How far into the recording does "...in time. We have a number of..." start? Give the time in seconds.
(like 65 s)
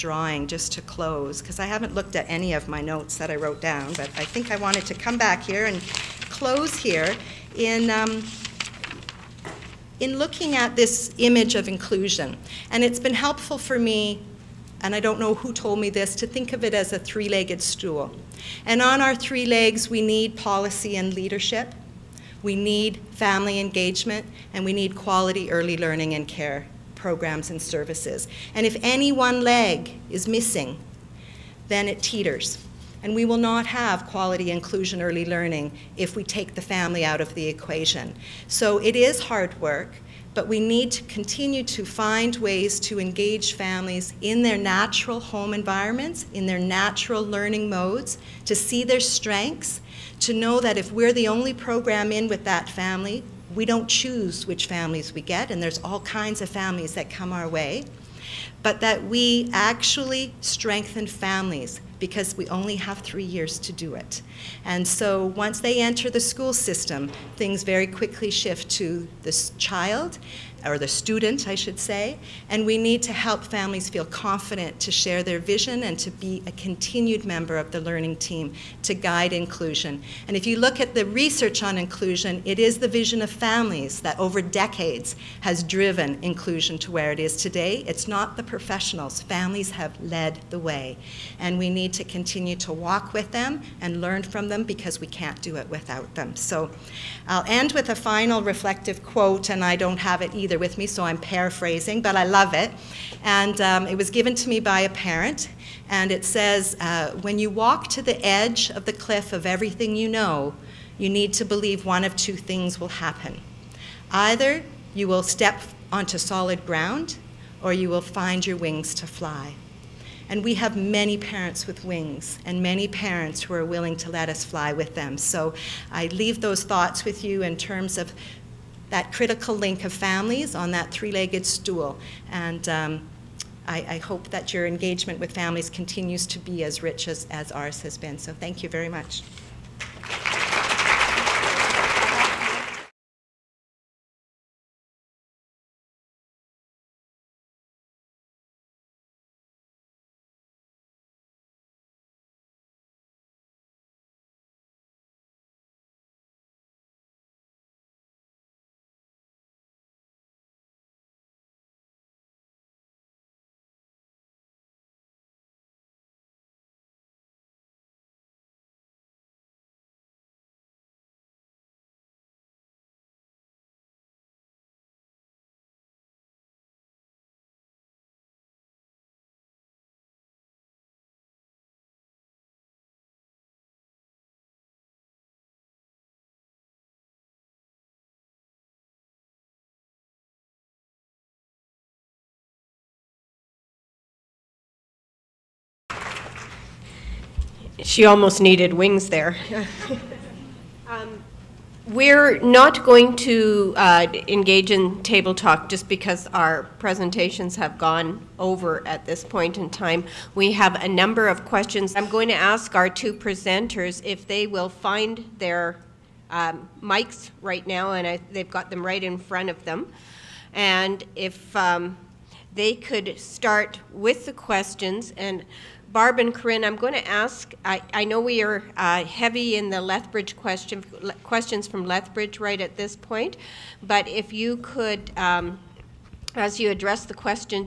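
209 s.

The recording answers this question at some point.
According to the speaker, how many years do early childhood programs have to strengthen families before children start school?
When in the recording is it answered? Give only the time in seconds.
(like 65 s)
62 s.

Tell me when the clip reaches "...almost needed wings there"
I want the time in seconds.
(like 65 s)
198 s.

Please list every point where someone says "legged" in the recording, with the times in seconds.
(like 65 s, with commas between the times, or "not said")
16 s, 131 s.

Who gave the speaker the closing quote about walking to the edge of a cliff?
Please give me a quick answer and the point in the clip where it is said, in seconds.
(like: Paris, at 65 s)
a parent, at 104 s.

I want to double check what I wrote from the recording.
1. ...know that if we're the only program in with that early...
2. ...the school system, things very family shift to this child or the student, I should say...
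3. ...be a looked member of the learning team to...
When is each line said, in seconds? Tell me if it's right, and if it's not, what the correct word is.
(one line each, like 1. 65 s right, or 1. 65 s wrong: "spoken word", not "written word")
1. 50 s wrong: "family", not "early"
2. 66 s wrong: "quickly", not "family"
3. 76 s wrong: "continued", not "looked".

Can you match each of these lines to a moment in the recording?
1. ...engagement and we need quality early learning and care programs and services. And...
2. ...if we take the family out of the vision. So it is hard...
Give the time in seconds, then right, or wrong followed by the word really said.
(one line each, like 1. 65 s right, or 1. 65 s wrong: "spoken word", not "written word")
1. 23 s right
2. 35 s wrong: "equation", not "vision".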